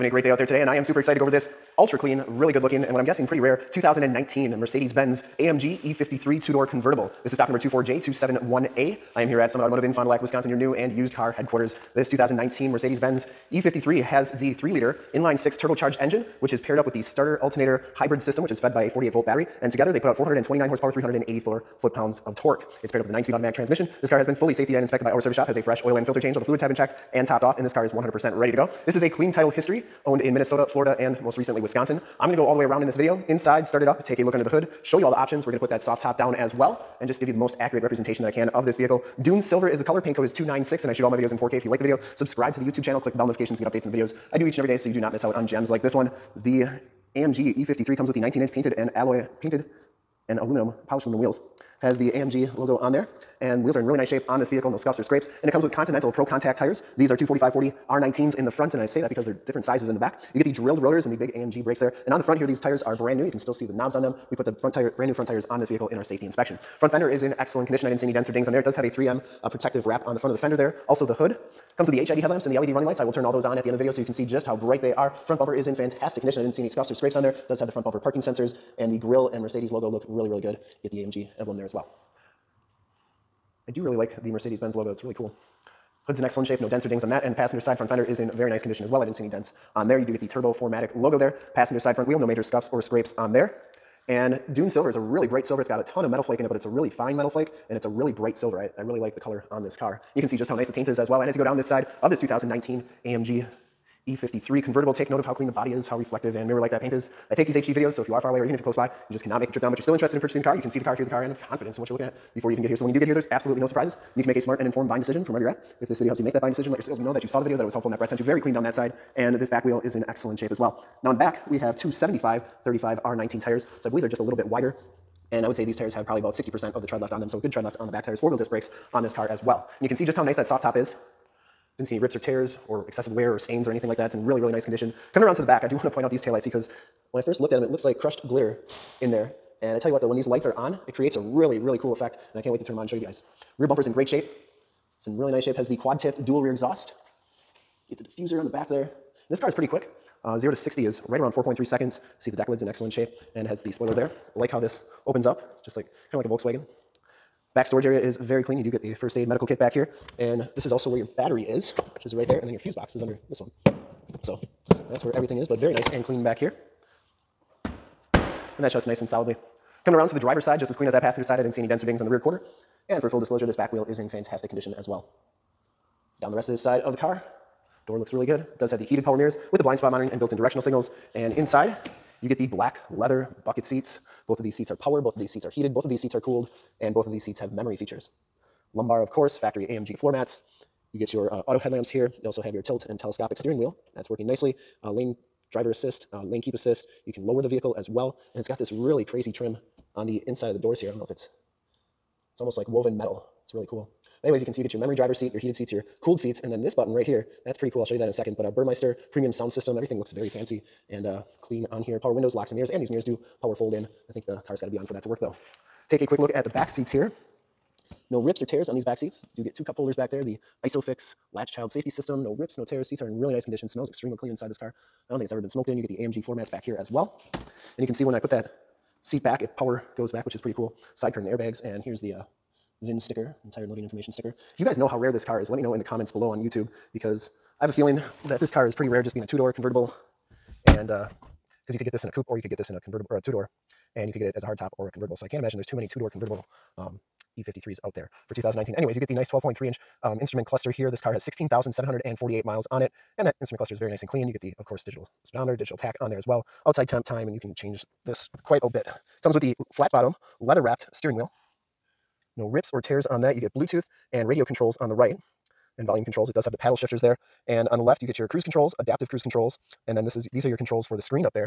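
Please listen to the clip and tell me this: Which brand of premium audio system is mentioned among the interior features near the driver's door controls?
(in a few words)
Burmester.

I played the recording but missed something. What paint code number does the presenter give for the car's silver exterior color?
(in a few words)
296.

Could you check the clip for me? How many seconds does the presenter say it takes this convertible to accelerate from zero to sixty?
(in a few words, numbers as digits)
4.3.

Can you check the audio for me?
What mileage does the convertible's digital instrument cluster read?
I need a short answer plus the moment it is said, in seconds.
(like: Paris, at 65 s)
16,748, at 251 s.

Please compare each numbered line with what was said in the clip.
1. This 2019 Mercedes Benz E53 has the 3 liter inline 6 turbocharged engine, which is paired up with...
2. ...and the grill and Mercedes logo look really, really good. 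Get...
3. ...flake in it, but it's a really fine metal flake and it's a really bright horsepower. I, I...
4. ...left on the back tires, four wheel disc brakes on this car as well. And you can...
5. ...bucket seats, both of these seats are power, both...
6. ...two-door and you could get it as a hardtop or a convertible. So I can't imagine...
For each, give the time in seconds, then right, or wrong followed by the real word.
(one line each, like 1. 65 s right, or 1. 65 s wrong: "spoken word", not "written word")
1. 11 s right
2. 78 s right
3. 96 s wrong: "silver", not "horsepower"
4. 127 s right
5. 183 s right
6. 243 s right.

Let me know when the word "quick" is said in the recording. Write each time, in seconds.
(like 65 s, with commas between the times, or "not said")
149 s, 216 s.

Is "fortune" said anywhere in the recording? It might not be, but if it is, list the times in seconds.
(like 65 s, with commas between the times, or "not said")
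not said.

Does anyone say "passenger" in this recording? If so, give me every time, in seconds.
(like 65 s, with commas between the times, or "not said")
87 s, 91 s, 171 s.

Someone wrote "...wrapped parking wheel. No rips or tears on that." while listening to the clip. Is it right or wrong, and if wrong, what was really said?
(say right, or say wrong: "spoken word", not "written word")
wrong: "steering", not "parking".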